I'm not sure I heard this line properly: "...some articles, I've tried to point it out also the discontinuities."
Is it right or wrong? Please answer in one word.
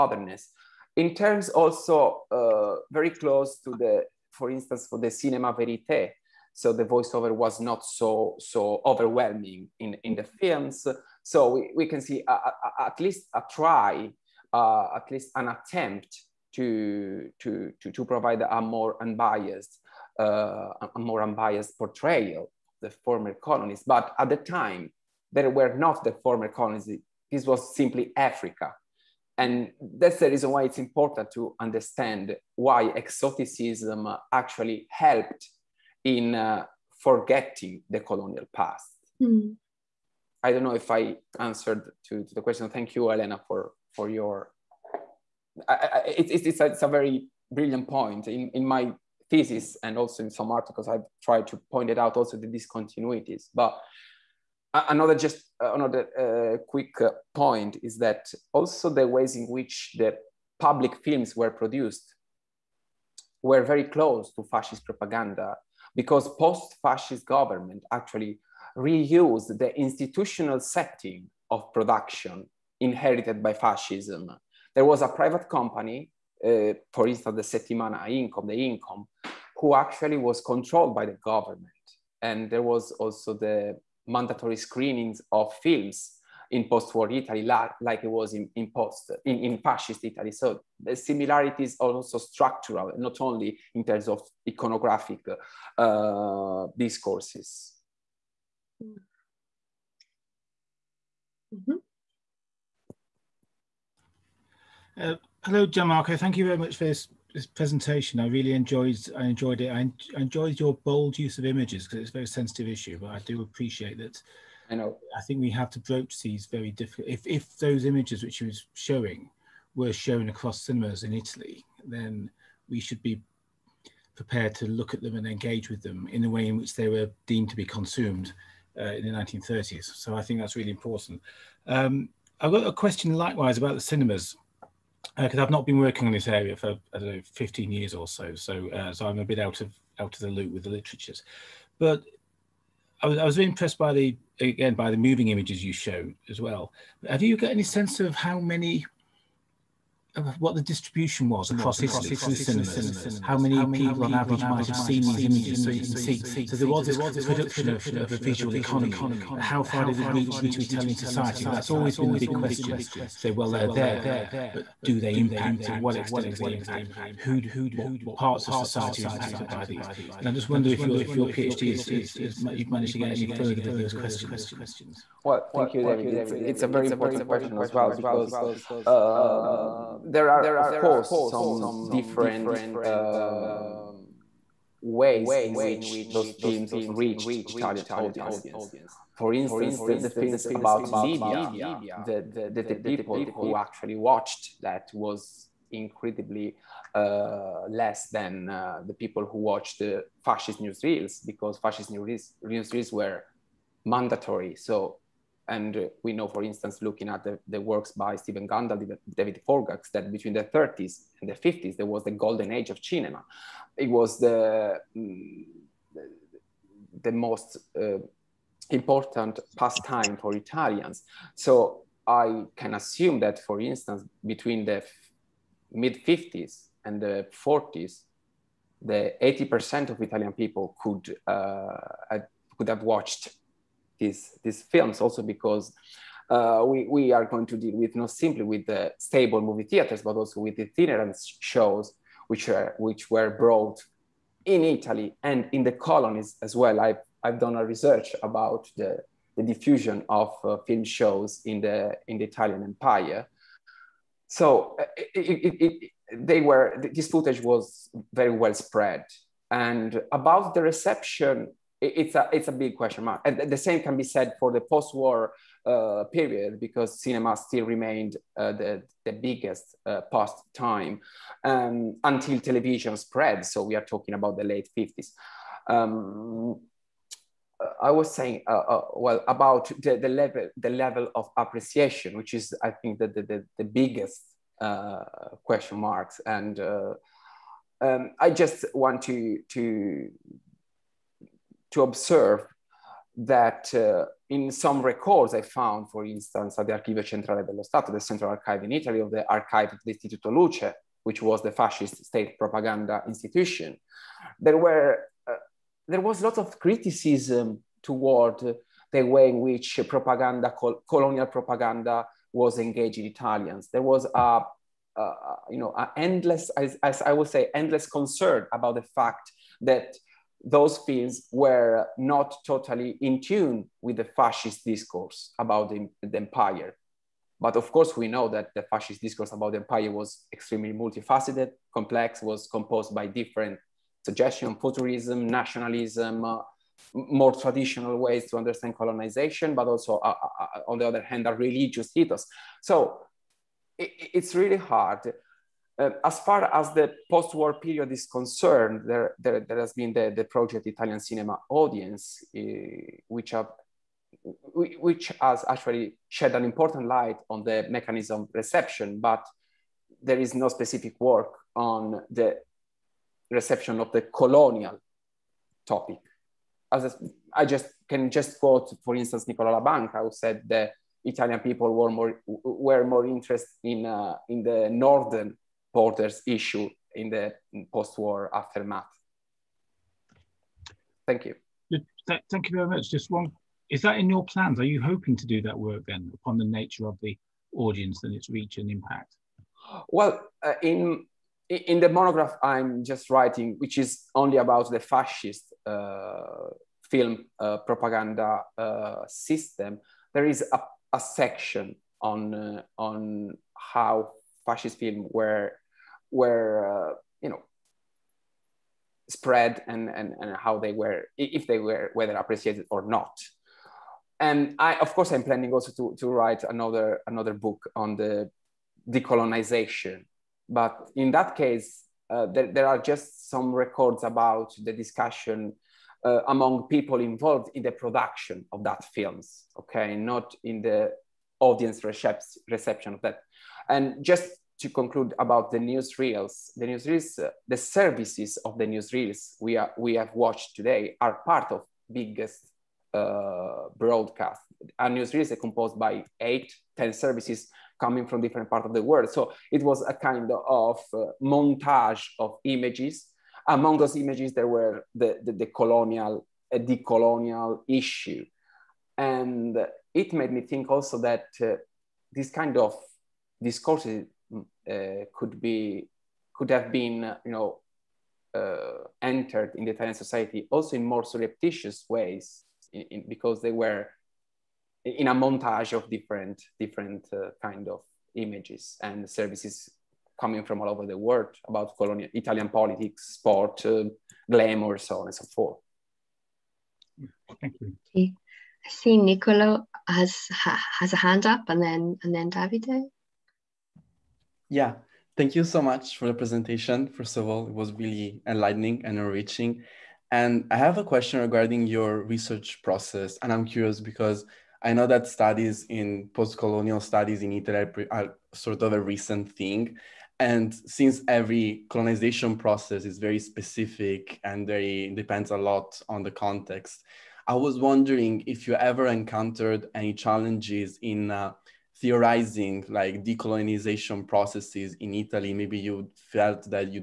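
right.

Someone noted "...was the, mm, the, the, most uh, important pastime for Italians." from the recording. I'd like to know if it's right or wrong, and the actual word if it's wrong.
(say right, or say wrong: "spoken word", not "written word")
right.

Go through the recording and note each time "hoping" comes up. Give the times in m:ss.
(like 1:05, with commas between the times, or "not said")
6:24.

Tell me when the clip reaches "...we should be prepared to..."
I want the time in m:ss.
2:02.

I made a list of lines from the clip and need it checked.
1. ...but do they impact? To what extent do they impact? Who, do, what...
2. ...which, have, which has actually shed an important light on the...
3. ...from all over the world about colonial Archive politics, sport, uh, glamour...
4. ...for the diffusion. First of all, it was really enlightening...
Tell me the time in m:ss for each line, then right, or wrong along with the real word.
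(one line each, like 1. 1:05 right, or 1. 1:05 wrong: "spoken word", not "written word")
1. 2:44 right
2. 5:53 right
3. 8:00 wrong: "Italian", not "Archive"
4. 8:15 wrong: "presentation", not "diffusion".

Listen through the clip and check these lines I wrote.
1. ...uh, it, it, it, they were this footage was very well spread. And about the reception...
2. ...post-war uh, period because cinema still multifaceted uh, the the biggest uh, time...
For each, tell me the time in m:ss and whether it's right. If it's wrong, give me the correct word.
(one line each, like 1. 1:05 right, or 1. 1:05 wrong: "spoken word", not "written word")
1. 4:14 right
2. 4:24 wrong: "remained", not "multifaceted".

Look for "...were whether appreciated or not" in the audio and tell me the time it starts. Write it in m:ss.
6:51.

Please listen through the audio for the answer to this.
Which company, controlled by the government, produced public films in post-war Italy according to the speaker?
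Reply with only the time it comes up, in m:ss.
1:17.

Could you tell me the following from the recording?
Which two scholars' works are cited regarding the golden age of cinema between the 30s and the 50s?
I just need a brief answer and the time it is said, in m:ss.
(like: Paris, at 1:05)
Stephen Gundle, David Forgacs, at 3:28.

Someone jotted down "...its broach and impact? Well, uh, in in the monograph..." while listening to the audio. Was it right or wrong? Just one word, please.
wrong.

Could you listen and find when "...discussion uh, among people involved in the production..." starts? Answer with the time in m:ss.
7:04.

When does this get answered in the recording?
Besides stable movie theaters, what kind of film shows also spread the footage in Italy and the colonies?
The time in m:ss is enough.
4:00.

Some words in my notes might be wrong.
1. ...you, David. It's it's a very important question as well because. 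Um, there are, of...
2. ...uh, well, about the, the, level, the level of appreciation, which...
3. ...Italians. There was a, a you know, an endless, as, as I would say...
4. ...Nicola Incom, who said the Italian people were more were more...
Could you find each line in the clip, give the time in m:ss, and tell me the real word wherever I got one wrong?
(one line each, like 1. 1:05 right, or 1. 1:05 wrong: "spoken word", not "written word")
1. 2:55 right
2. 4:38 right
3. 5:13 right
4. 6:09 wrong: "Labanca", not "Incom".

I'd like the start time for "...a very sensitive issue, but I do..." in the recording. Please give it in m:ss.
1:52.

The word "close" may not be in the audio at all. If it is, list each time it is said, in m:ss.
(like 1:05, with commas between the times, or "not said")
0:03, 1:03.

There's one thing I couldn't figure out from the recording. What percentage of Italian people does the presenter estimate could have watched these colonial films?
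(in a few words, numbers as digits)
80%.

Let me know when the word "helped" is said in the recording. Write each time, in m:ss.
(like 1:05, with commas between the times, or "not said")
0:34.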